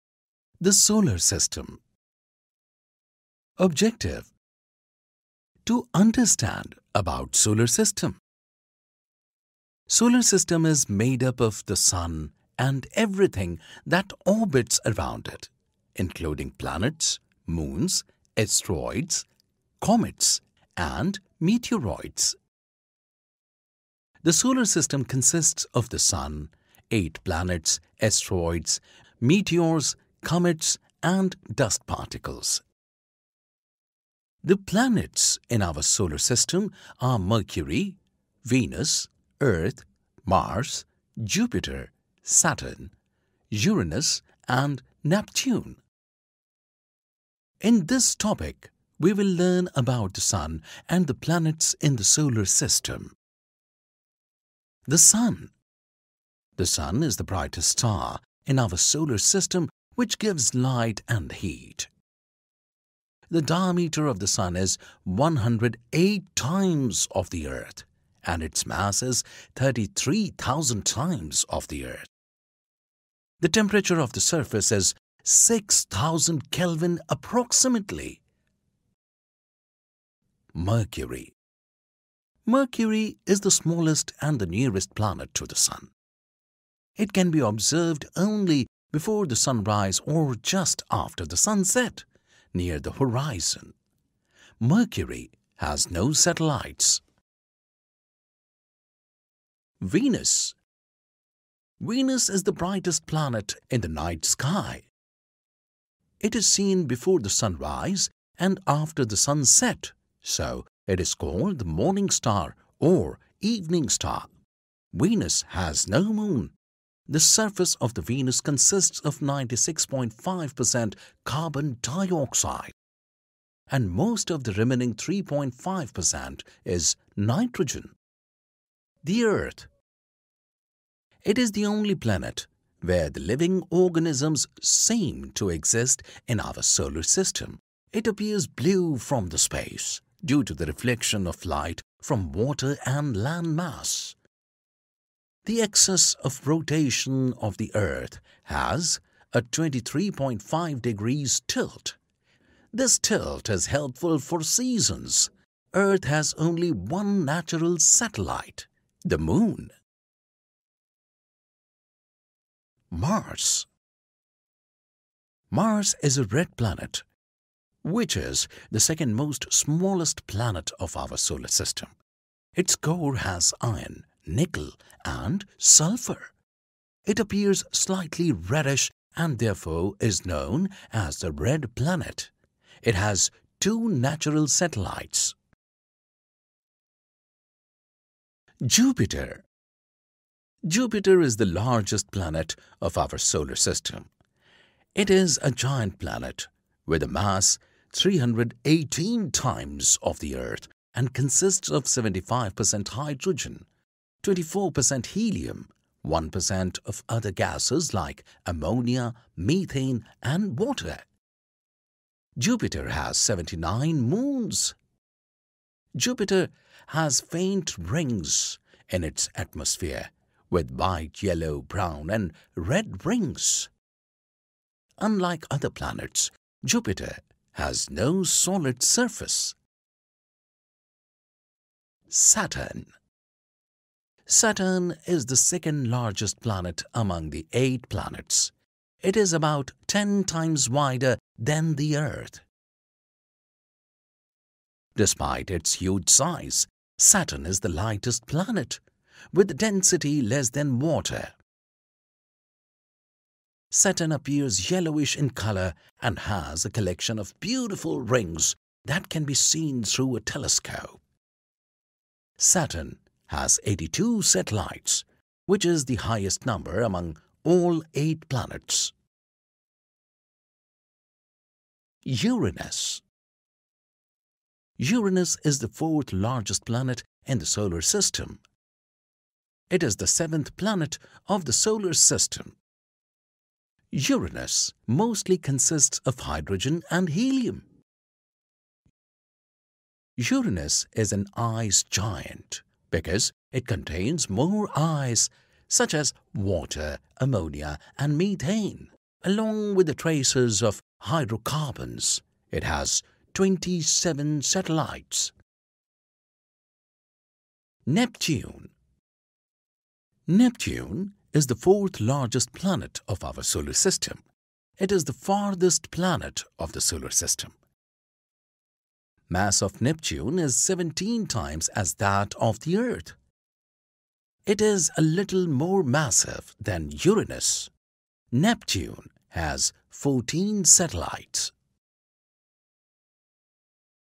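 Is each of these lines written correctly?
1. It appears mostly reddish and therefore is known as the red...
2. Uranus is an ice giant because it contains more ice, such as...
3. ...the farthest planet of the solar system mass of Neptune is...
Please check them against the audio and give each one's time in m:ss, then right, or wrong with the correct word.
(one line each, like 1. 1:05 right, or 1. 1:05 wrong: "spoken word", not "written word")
1. 2:57 wrong: "slightly", not "mostly"
2. 4:50 right
3. 5:15 right.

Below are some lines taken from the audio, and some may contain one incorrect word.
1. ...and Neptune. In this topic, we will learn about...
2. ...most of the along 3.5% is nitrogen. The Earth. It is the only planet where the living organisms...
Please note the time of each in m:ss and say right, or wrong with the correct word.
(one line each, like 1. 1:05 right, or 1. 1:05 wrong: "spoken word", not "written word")
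1. 0:44 right
2. 2:03 wrong: "remaining", not "along".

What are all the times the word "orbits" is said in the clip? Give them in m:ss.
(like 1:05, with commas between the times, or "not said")
0:14.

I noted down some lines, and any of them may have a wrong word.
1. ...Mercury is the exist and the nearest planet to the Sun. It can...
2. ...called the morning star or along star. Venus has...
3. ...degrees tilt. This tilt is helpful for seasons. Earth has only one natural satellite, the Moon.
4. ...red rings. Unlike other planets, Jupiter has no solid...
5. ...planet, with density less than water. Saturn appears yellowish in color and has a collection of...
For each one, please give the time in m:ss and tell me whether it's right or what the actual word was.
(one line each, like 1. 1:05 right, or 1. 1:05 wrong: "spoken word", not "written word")
1. 1:22 wrong: "smallest", not "exist"
2. 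1:51 wrong: "evening", not "along"
3. 2:30 right
4. 3:42 right
5. 4:08 right.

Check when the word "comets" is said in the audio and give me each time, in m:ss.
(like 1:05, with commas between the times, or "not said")
0:19, 0:30.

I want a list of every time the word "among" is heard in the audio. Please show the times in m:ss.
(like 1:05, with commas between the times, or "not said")
3:56, 4:26.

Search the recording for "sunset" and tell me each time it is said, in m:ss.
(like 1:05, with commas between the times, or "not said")
1:31, 1:49.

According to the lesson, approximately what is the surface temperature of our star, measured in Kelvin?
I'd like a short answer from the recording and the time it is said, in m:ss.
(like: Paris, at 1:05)
6,000 Kelvin, at 1:15.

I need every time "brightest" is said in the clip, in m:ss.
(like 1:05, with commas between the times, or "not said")
0:57, 1:42.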